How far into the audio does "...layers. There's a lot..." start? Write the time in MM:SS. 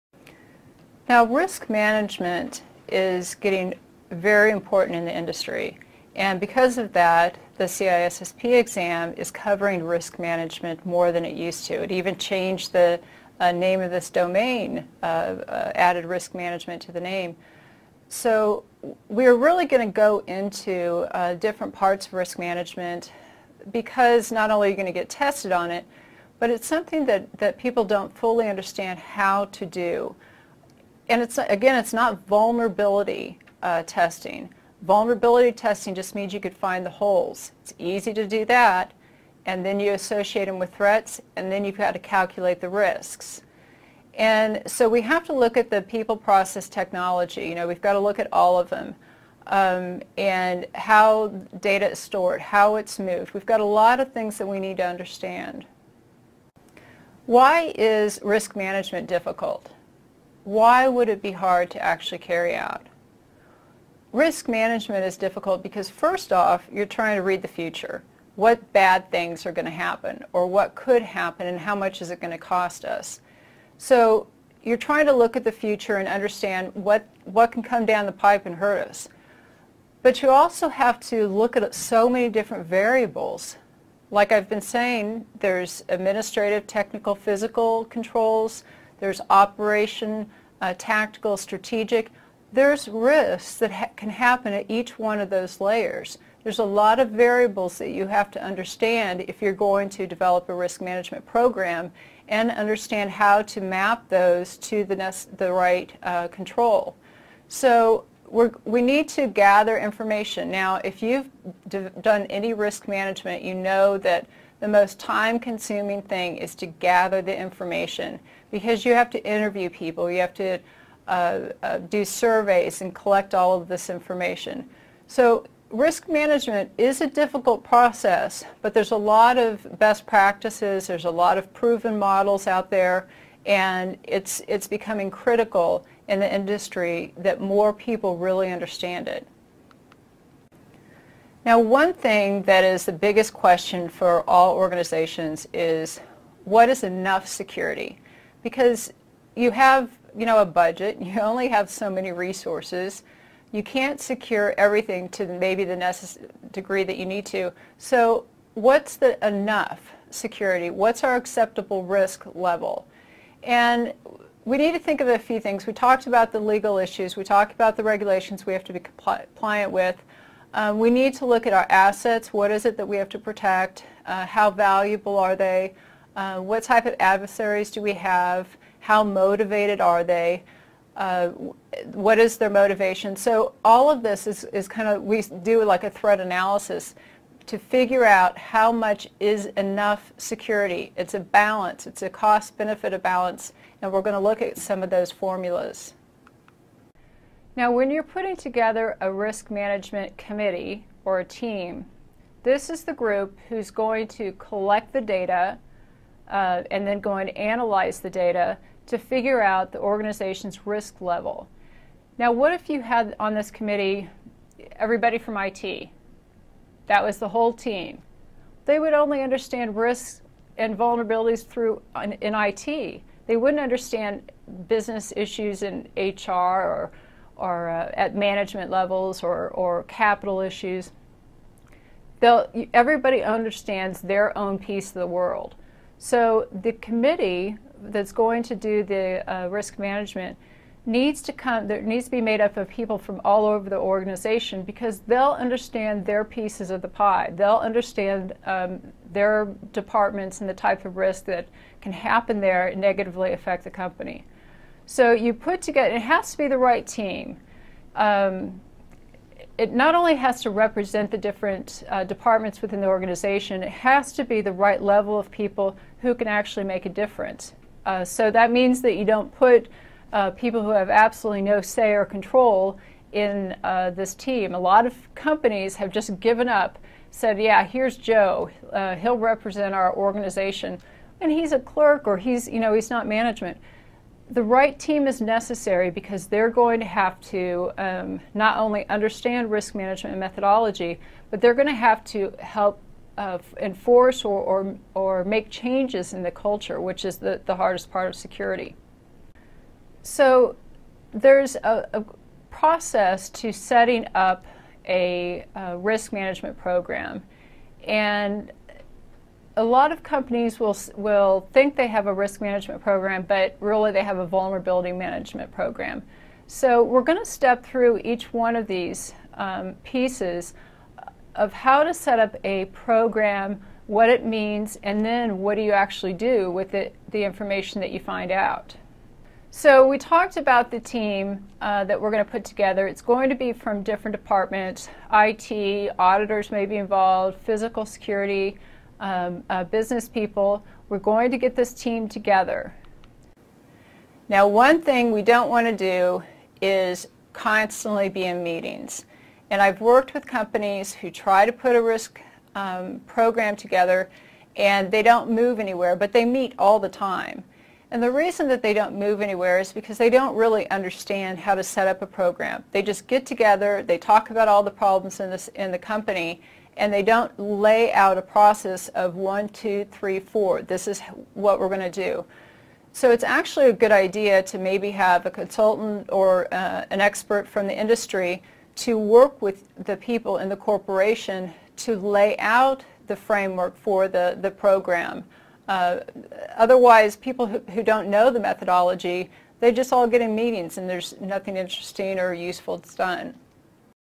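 01:35.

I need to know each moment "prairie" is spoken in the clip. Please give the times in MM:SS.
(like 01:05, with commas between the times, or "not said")
not said.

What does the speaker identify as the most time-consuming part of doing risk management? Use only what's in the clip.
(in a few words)
gather the information.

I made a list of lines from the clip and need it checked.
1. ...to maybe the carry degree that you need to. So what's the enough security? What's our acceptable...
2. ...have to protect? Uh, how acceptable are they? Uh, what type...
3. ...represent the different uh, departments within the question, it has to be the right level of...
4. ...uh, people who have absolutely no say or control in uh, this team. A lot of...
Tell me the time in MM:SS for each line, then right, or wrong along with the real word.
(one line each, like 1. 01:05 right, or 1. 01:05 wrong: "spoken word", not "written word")
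1. 02:35 wrong: "necessary", not "carry"
2. 02:52 wrong: "valuable", not "acceptable"
3. 04:20 wrong: "organization", not "question"
4. 04:30 right.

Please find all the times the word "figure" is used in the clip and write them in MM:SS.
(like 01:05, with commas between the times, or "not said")
03:07, 03:28.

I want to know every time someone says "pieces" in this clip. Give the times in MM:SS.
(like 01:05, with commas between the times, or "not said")
03:54, 04:06, 05:19.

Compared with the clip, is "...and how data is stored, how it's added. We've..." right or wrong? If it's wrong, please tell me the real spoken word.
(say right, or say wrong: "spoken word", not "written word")
wrong: "moved", not "added".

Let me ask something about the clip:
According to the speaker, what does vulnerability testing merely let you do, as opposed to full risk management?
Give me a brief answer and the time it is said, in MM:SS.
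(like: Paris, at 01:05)
find the holes, at 00:36.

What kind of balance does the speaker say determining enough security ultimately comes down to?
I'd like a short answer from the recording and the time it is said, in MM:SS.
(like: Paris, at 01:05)
cost-benefit balance, at 03:12.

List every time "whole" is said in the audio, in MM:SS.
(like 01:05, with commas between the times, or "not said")
03:37.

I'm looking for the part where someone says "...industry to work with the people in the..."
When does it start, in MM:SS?
06:17.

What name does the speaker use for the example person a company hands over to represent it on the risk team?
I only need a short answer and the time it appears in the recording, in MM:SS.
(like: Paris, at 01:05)
Joe, at 04:37.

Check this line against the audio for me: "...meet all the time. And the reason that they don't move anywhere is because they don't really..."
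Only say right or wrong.
right.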